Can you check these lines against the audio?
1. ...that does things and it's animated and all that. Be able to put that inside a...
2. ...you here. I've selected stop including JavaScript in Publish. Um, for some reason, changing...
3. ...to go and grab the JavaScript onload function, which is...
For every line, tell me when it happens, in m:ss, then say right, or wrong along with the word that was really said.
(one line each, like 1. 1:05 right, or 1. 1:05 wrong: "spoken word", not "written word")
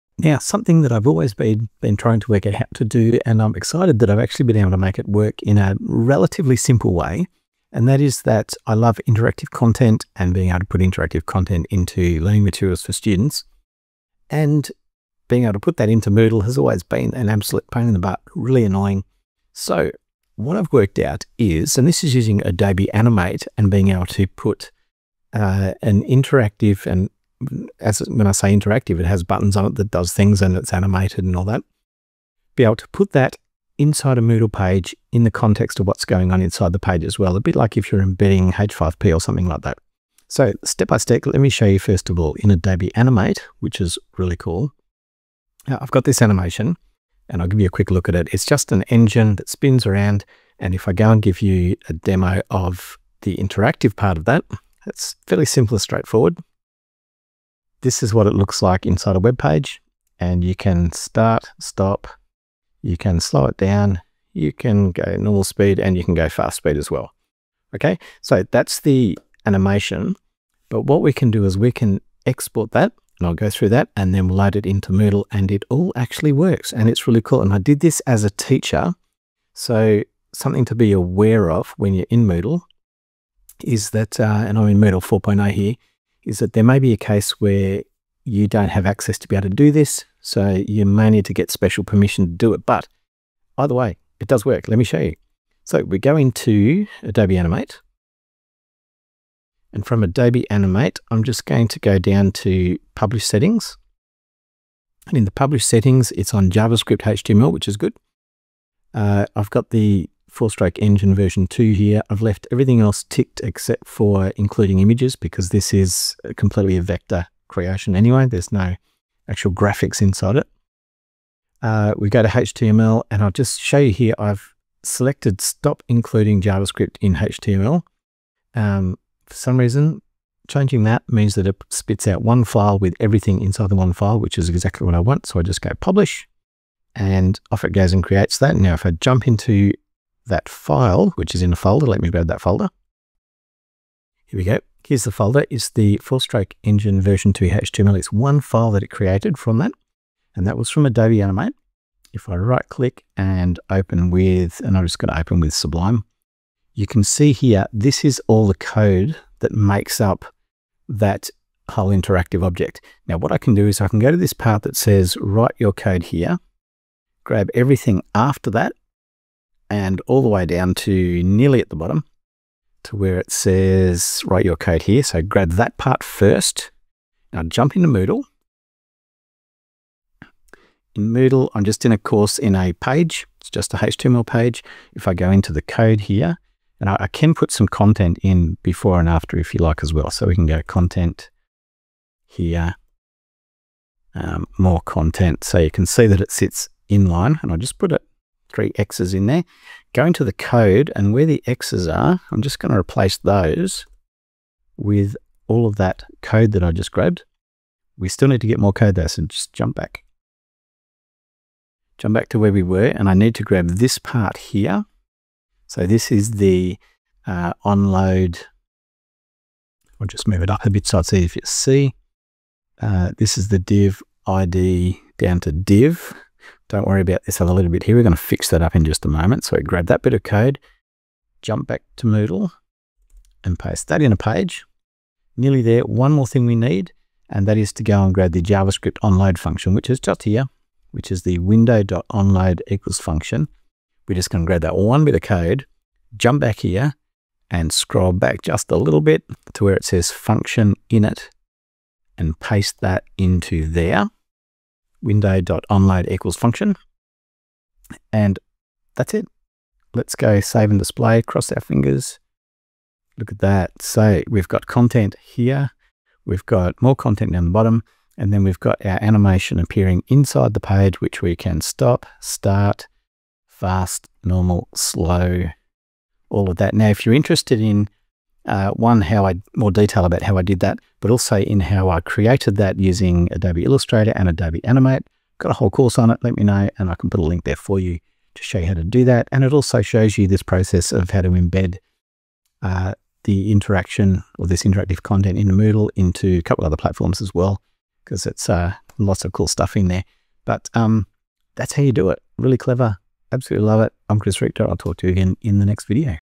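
1. 0:29 right
2. 2:03 wrong: "HTML", not "Publish"
3. 3:57 right.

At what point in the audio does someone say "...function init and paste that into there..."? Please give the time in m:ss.
4:10.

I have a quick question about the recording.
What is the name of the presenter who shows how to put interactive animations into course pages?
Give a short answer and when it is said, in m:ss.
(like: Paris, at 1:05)
Chris Richter, at 5:04.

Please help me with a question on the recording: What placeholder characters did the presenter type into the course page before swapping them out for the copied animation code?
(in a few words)
three X's.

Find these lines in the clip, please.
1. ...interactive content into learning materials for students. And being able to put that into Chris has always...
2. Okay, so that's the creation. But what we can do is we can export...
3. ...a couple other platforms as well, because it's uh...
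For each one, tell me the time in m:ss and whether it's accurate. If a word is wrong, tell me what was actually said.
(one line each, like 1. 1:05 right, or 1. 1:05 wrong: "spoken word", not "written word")
1. 0:10 wrong: "Moodle", not "Chris"
2. 1:07 wrong: "animation", not "creation"
3. 4:56 right.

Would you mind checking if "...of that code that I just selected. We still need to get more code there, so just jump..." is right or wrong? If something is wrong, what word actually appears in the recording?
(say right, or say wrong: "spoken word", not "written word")
wrong: "grabbed", not "selected".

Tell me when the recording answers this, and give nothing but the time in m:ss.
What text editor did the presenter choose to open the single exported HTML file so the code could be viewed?
2:35.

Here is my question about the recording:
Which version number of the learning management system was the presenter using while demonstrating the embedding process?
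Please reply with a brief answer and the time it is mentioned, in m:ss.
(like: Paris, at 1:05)
Moodle 4.0, at 1:24.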